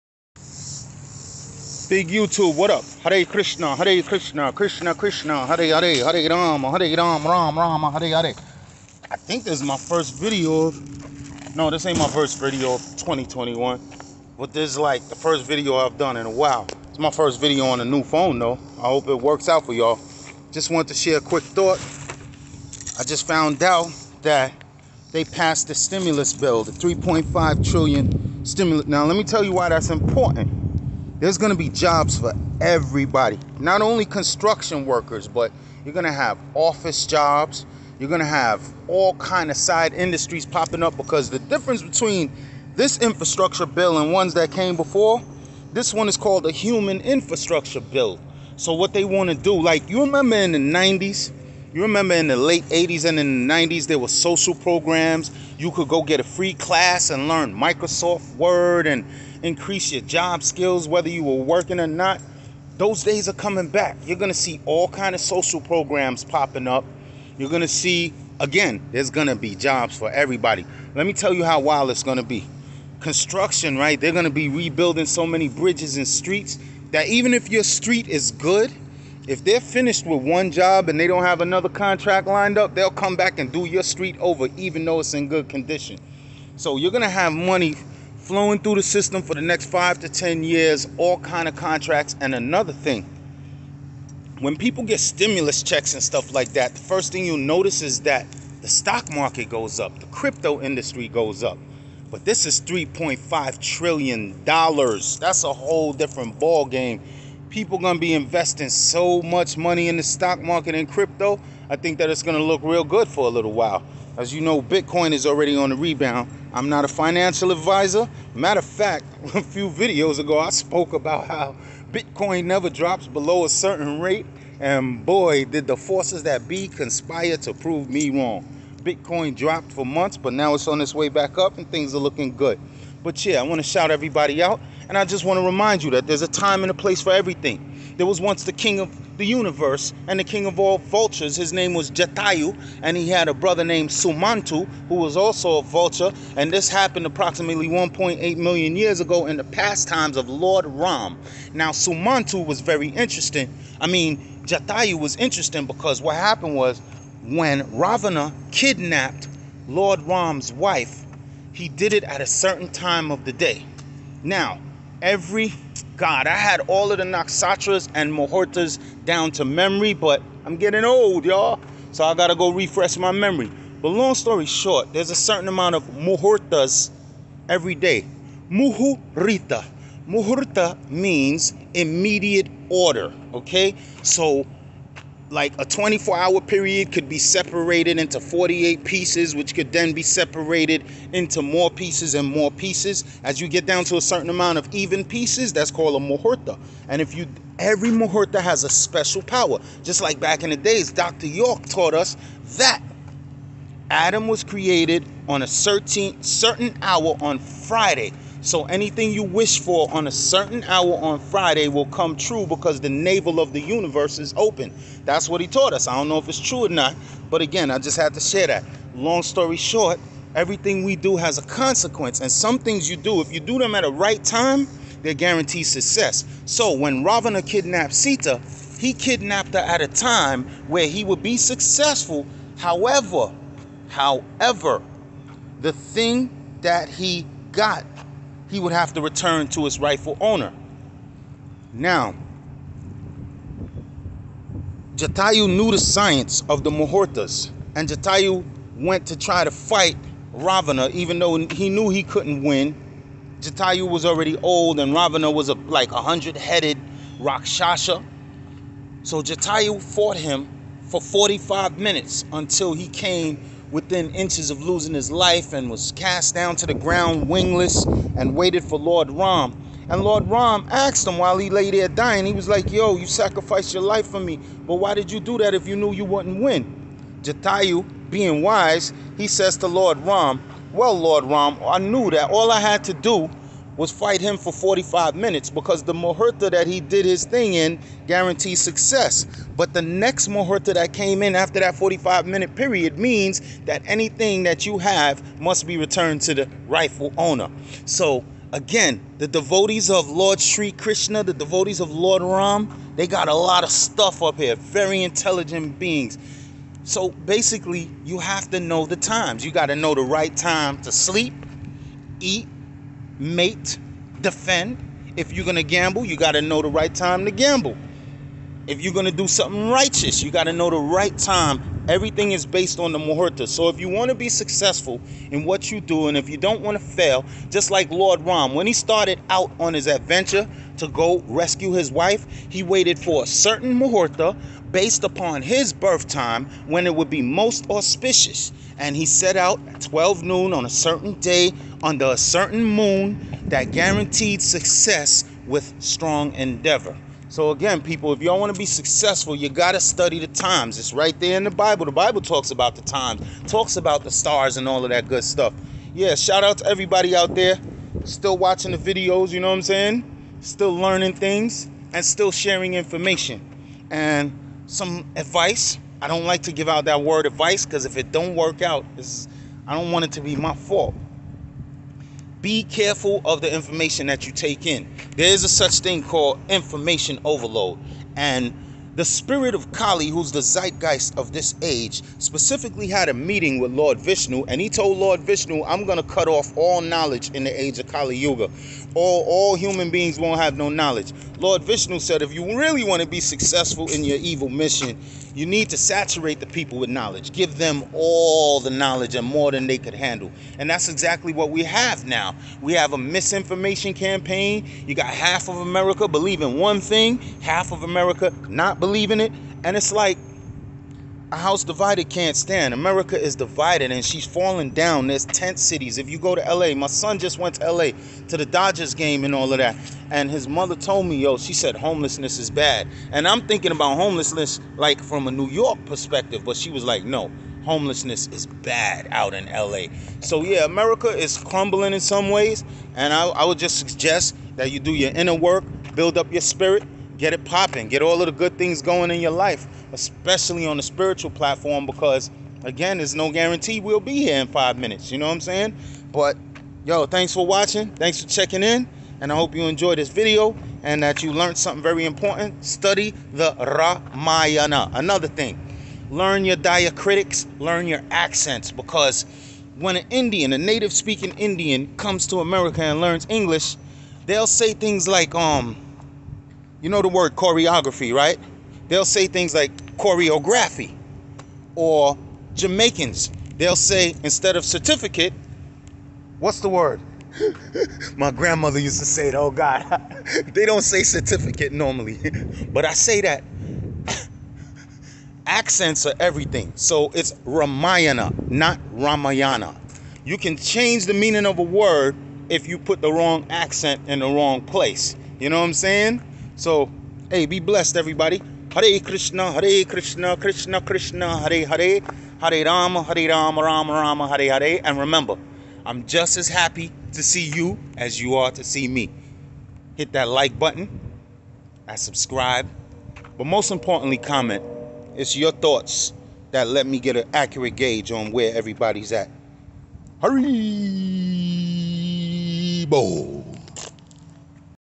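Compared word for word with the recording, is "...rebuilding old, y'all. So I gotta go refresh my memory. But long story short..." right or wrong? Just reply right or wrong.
wrong.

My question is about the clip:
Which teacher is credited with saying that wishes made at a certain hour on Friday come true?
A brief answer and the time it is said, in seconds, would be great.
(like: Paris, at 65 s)
Dr. York, at 200 s.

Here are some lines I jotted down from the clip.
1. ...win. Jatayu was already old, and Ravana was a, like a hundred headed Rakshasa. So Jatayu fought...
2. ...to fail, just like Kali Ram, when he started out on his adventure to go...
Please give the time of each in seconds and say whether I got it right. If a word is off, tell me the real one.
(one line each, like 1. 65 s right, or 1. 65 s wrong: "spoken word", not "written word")
1. 252 s right
2. 326 s wrong: "Lord", not "Kali".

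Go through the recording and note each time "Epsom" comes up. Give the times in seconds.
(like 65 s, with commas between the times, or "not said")
not said.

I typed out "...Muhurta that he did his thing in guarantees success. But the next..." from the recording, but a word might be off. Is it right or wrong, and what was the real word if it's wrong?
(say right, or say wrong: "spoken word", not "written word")
right.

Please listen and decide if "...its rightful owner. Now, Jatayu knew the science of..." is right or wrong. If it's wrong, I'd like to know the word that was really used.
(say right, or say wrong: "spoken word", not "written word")
right.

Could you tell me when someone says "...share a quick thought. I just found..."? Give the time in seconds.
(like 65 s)
20 s.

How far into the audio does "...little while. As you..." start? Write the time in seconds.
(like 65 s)
113 s.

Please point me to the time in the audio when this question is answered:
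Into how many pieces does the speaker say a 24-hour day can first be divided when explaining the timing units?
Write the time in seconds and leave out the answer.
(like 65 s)
188 s.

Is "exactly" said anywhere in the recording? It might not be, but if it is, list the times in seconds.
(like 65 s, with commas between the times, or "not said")
400 s.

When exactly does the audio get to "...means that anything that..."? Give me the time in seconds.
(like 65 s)
292 s.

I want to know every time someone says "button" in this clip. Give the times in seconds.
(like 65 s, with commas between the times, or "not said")
510 s.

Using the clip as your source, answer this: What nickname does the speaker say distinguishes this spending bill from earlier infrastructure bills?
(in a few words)
human infrastructure bill.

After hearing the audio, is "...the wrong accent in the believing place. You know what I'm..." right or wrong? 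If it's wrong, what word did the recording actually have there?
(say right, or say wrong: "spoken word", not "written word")
wrong: "wrong", not "believing".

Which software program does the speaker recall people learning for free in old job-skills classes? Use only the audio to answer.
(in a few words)
Microsoft Word.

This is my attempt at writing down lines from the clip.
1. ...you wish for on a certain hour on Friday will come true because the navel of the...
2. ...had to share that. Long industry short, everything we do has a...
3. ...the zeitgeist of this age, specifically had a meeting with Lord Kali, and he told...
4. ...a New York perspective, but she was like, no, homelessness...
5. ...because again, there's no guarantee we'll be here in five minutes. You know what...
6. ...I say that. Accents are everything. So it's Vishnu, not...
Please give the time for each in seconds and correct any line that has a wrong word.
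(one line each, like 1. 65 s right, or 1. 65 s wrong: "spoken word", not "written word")
1. 209 s right
2. 217 s wrong: "story", not "industry"
3. 380 s wrong: "Vishnu", not "Kali"
4. 425 s right
5. 441 s right
6. 482 s wrong: "Ramayana", not "Vishnu".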